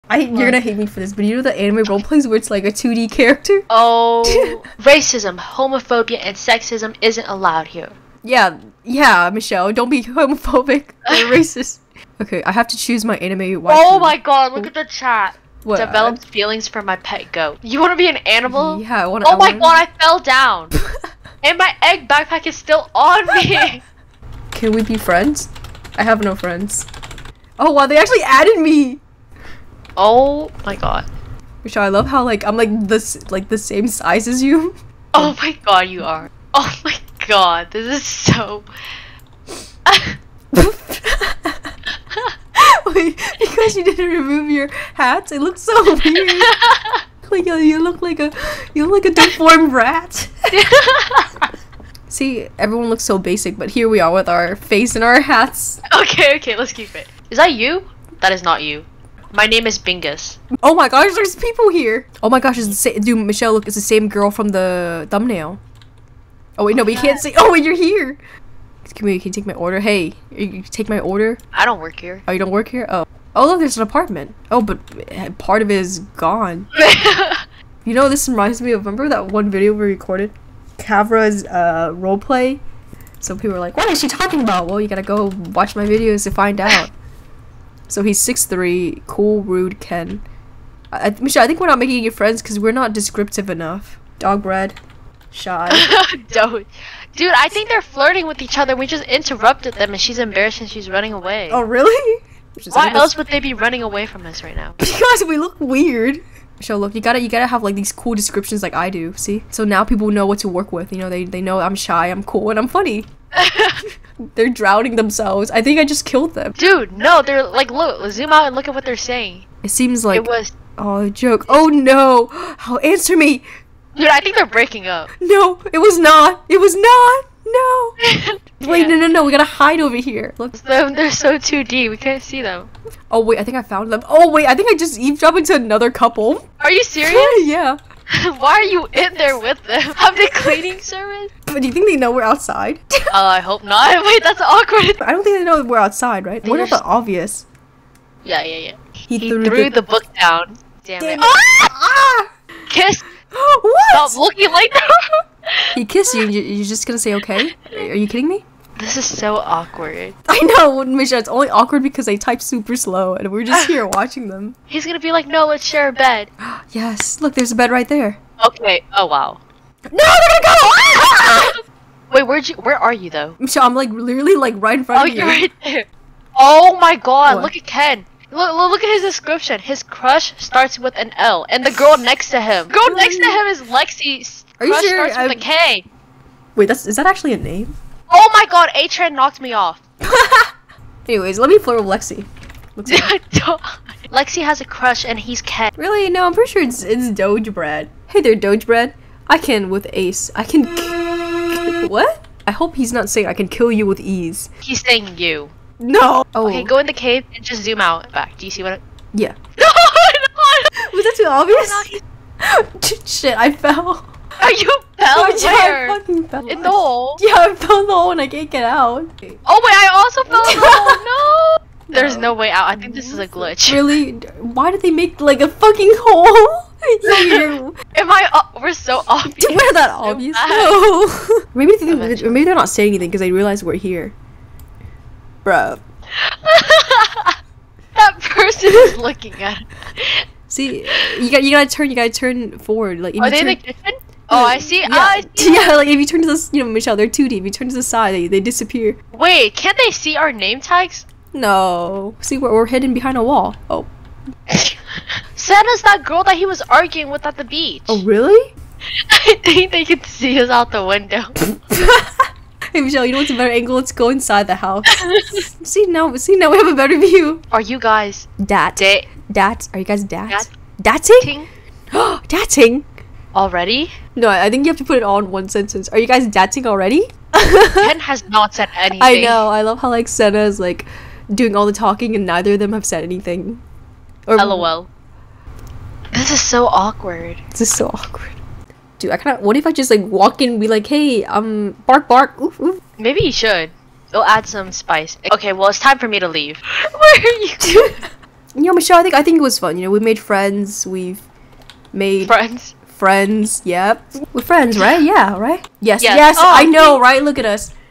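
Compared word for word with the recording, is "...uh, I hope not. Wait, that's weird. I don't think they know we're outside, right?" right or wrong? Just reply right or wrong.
wrong.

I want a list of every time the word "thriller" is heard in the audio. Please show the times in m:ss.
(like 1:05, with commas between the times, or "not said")
not said.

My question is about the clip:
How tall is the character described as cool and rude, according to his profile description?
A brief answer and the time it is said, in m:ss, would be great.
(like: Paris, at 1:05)
6'3, at 1:28.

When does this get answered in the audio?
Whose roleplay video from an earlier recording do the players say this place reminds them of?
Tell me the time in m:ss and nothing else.
1:20.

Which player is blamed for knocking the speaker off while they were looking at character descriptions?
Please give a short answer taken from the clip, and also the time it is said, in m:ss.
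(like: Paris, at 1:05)
A-Train, at 3:08.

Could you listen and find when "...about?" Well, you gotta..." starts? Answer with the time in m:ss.
1:24.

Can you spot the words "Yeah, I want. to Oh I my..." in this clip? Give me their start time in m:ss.
0:18.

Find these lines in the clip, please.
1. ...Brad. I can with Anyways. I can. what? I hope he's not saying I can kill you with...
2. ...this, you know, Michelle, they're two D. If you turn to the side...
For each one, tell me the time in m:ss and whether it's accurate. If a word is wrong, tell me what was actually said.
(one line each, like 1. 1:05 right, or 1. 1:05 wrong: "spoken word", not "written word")
1. 3:18 wrong: "Ace", not "Anyways"
2. 4:06 right.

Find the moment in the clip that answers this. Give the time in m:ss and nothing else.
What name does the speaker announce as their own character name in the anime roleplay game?
0:59.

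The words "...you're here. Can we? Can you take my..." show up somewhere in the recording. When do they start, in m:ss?
1:07.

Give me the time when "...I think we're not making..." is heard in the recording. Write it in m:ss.
1:31.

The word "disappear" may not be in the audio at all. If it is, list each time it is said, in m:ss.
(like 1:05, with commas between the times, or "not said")
4:08.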